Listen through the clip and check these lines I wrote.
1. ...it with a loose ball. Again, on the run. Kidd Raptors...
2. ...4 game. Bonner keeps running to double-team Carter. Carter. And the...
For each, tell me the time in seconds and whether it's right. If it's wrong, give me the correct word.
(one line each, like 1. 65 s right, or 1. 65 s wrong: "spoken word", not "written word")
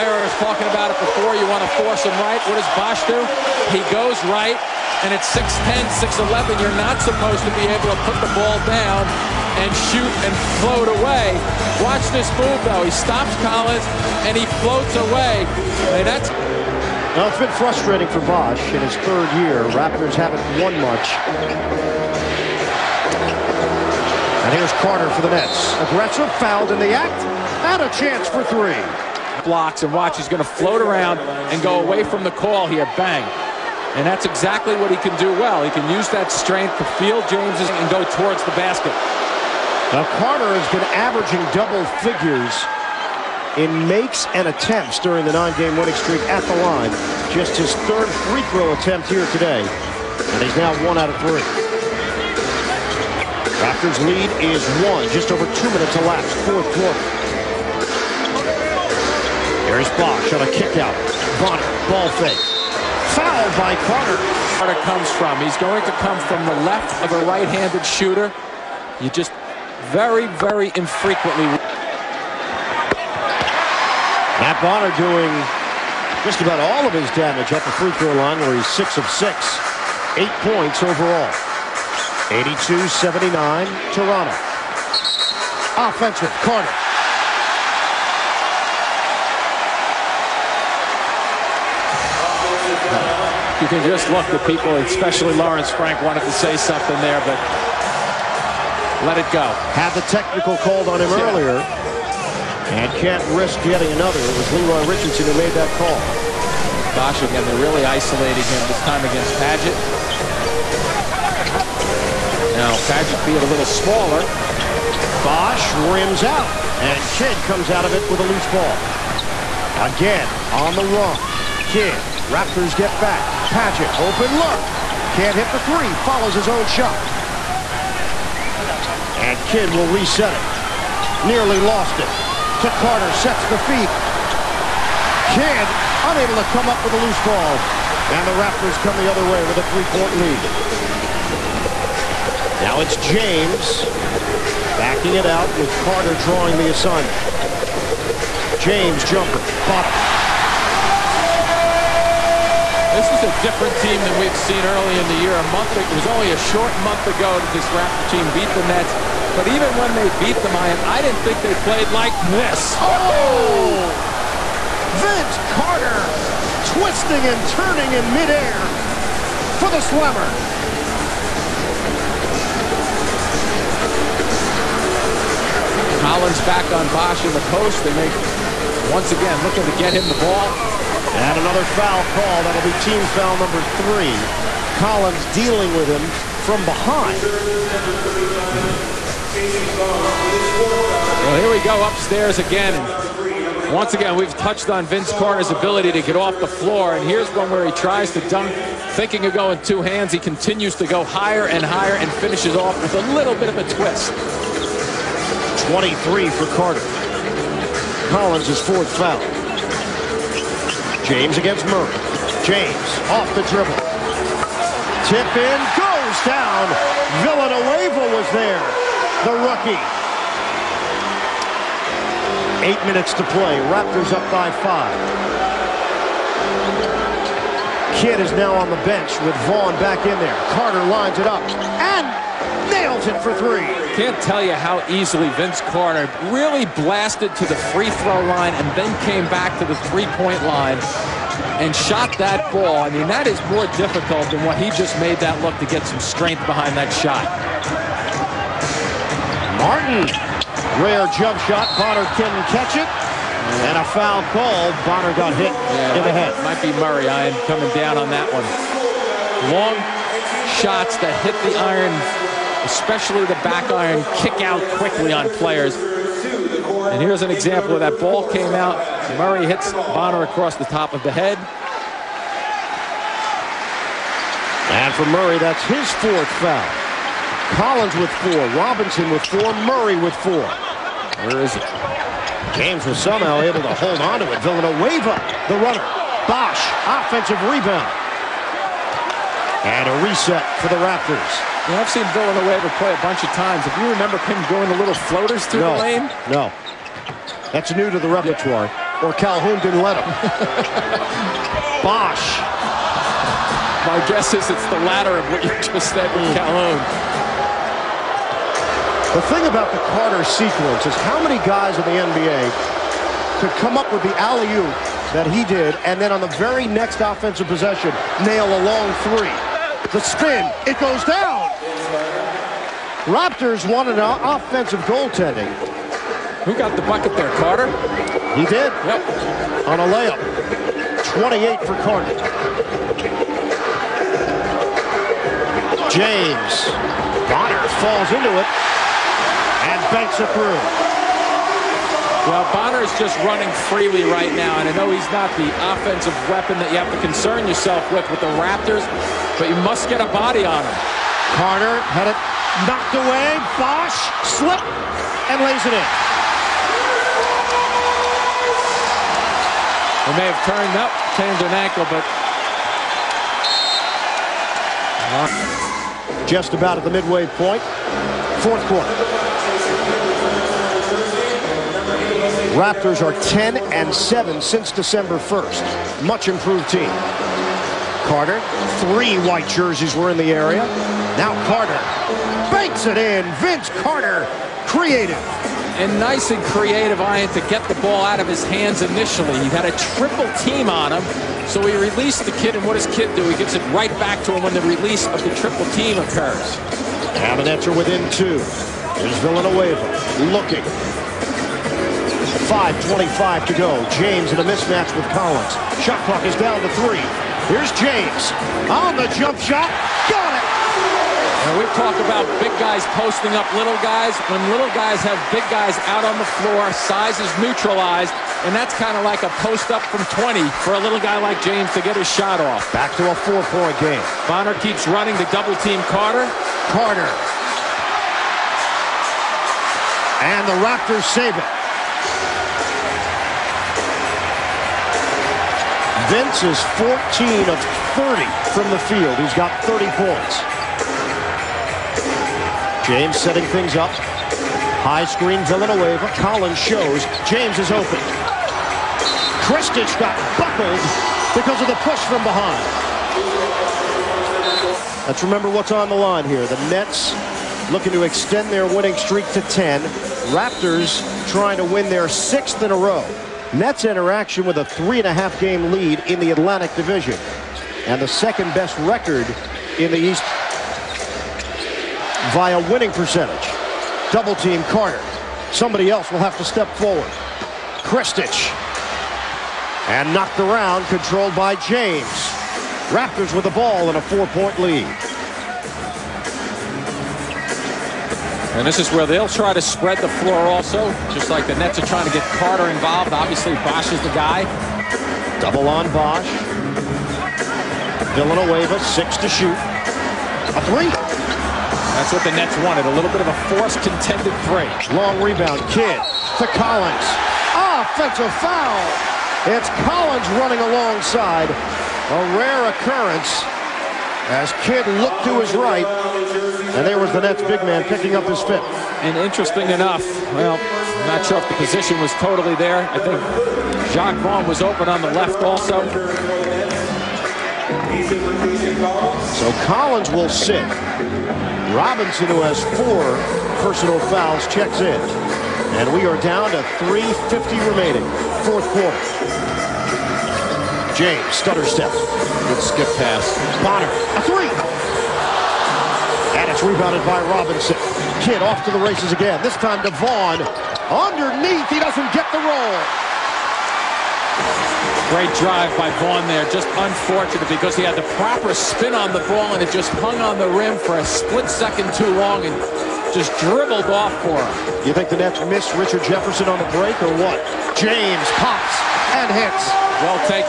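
1. 117 s right
2. 423 s right.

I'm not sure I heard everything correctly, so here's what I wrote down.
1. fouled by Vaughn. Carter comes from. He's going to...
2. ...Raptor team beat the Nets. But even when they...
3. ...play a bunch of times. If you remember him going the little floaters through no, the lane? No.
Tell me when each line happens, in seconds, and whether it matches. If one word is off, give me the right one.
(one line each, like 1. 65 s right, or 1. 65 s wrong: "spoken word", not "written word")
1. 63 s wrong: "Carter", not "Vaughn"
2. 157 s right
3. 292 s right.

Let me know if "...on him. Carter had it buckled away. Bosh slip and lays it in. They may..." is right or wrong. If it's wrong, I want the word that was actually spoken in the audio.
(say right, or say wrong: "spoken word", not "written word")
wrong: "knocked", not "buckled".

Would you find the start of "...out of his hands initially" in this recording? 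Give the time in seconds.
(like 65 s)
388 s.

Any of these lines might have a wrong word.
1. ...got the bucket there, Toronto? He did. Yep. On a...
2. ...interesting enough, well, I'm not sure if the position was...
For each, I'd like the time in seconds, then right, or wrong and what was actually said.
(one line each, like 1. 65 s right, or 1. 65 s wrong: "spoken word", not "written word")
1. 326 s wrong: "Carter", not "Toronto"
2. 519 s right.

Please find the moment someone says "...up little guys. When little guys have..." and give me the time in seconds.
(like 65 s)
413 s.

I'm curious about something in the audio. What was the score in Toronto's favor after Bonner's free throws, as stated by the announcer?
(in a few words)
82-79.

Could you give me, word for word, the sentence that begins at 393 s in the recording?
He gives it right back to him when the release of the triple team occurs.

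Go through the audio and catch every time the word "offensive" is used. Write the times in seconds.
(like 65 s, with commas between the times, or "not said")
85 s, 286 s, 317 s, 324 s, 345 s, 507 s.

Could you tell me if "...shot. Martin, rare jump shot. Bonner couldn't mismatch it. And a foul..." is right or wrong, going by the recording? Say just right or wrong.
wrong.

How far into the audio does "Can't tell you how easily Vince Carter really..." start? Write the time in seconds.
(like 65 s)
234 s.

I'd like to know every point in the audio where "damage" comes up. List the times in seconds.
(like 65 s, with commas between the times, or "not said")
77 s.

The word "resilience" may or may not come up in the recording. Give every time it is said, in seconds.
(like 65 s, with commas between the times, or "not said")
not said.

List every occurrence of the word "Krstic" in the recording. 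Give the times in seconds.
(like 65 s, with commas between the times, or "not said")
449 s, 477 s.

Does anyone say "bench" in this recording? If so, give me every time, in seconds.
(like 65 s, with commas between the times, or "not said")
228 s.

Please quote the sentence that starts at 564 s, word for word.
You think the Nets missed Richard Jefferson on the break or what?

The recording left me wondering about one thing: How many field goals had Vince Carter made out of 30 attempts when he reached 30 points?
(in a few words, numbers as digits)
14.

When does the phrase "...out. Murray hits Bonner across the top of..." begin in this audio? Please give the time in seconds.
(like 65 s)
268 s.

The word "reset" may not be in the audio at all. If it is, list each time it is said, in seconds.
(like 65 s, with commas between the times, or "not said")
129 s, 290 s.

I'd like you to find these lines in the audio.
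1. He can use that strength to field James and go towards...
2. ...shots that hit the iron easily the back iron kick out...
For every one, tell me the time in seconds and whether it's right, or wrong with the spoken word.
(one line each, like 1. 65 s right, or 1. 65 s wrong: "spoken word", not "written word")
1. 35 s right
2. 260 s wrong: "especially", not "easily".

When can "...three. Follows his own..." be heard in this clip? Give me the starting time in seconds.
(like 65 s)
125 s.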